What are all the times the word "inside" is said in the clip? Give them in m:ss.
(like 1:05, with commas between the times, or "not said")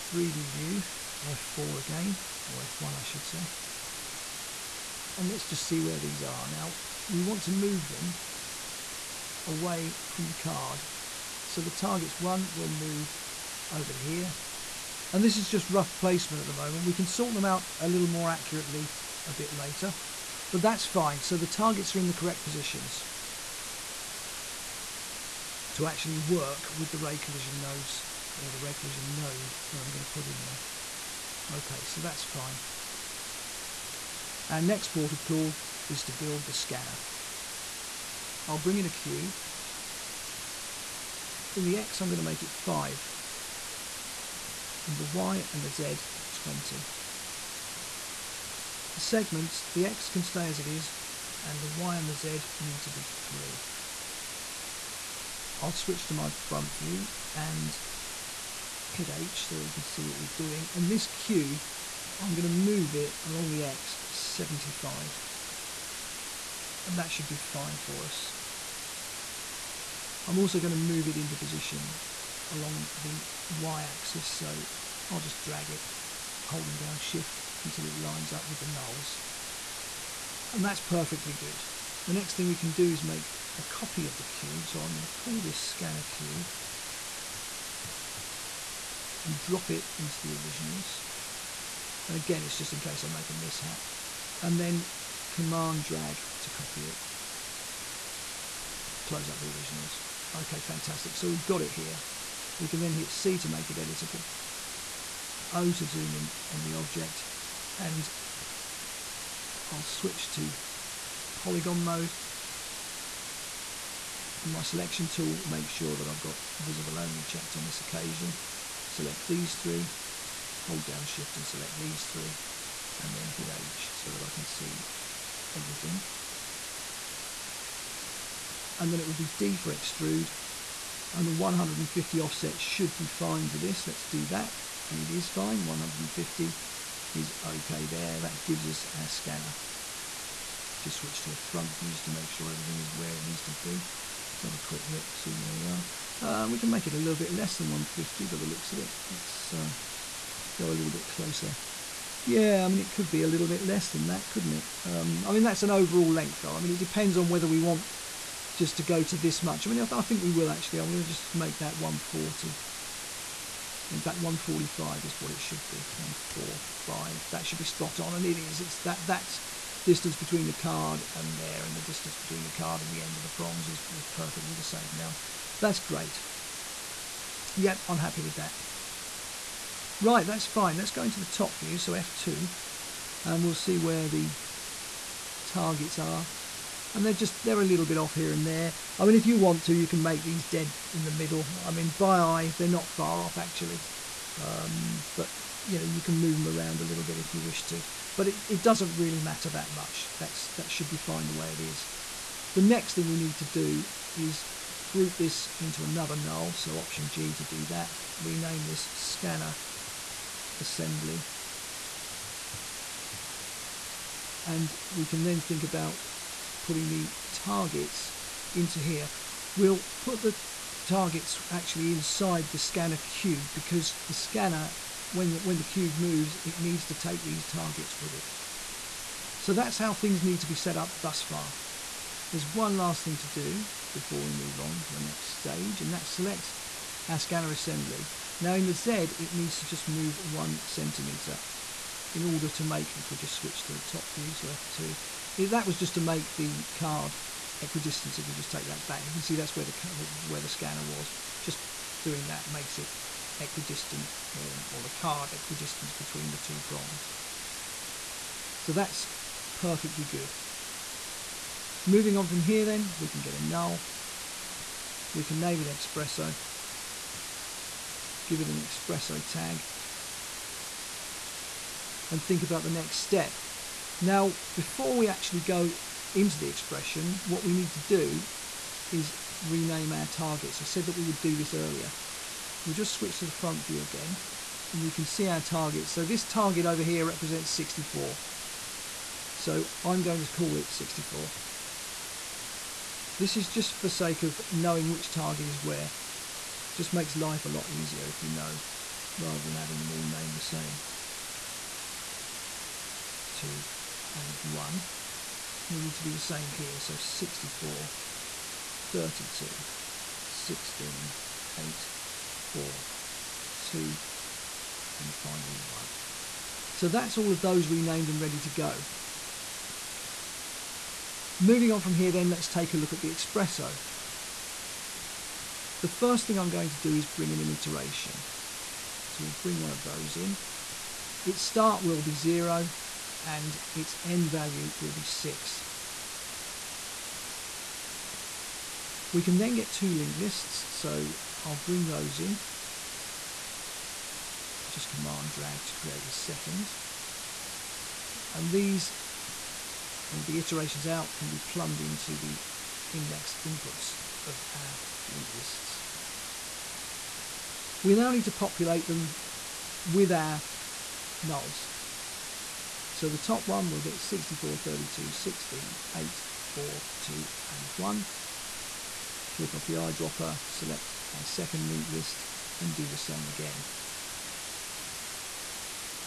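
3:41.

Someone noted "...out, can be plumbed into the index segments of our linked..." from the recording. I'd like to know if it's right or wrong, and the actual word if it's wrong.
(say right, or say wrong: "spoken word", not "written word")
wrong: "inputs", not "segments".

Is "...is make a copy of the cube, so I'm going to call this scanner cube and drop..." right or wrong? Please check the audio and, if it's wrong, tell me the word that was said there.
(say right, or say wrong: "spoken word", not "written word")
right.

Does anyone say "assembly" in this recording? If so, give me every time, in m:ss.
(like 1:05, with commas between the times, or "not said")
3:30, 3:57.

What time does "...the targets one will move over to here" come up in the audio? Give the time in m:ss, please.
0:11.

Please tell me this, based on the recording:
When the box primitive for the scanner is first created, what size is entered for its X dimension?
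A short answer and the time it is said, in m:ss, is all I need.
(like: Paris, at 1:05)
5, at 0:42.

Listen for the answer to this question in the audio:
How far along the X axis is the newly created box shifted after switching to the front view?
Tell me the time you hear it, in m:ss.
1:03.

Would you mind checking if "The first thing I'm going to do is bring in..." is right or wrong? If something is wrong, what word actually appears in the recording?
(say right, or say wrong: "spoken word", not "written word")
right.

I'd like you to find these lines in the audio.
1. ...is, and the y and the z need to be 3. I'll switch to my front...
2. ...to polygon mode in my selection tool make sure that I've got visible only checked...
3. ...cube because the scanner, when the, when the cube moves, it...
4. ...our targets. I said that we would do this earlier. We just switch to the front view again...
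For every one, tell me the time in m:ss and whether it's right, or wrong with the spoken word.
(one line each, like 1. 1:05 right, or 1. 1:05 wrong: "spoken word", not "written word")
1. 0:50 right
2. 1:50 right
3. 3:42 right
4. 4:39 right.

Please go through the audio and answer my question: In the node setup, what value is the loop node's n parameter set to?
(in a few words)
6.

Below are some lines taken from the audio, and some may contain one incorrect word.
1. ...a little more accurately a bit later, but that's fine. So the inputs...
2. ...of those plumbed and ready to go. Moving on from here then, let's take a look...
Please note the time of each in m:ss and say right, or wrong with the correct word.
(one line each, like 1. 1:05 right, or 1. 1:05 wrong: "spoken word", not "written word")
1. 0:17 wrong: "targets", not "inputs"
2. 5:17 wrong: "renamed", not "plumbed".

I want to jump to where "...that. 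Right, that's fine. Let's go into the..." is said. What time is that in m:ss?
2:58.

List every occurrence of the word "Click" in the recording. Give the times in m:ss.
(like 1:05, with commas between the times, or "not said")
6:09.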